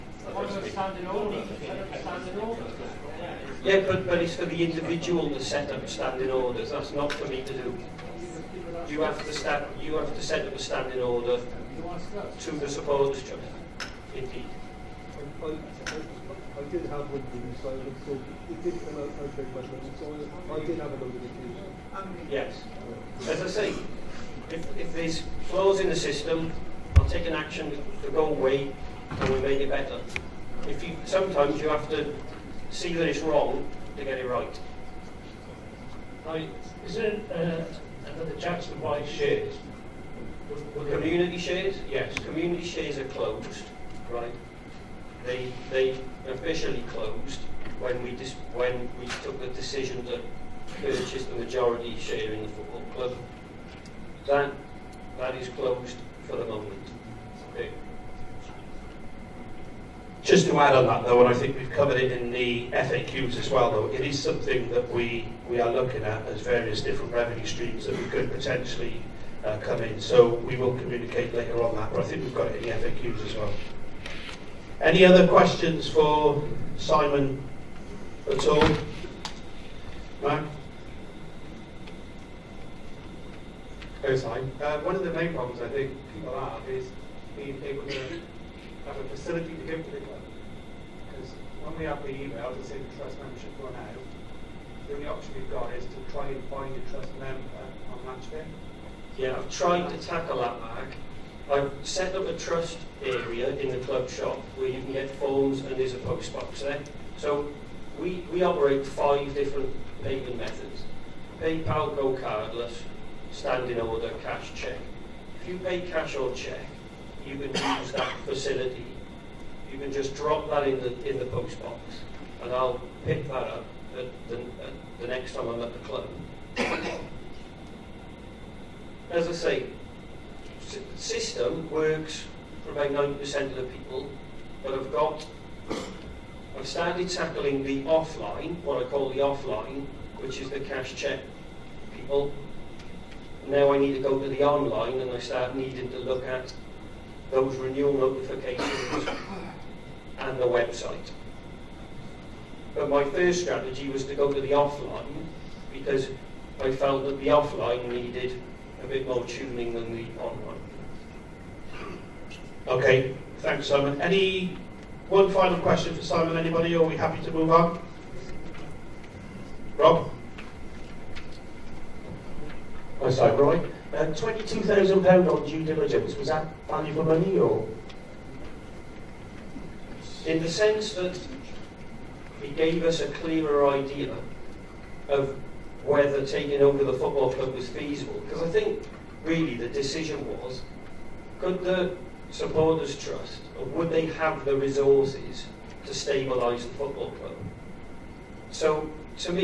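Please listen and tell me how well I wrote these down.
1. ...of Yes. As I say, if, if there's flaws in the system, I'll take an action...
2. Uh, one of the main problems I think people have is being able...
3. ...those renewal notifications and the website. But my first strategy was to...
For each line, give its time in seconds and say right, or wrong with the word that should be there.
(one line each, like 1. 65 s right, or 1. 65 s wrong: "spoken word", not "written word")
1. 21 s right
2. 84 s right
3. 147 s right.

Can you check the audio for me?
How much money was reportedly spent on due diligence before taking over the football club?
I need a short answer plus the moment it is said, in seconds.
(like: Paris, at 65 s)
£22,000, at 174 s.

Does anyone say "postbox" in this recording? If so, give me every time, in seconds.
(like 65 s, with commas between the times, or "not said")
105 s, 121 s.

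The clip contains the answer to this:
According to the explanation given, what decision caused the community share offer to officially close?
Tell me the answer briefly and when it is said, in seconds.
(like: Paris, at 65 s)
Purchase the majority share in the football club, at 50 s.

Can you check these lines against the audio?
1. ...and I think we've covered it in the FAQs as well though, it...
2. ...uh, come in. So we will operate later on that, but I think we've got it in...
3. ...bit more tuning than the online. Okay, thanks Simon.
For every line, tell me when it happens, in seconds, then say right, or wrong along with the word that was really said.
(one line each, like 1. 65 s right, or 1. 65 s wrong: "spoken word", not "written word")
1. 61 s right
2. 69 s wrong: "communicate", not "operate"
3. 158 s right.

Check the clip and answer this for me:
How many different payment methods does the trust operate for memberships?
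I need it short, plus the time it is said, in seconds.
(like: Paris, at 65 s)
5, at 108 s.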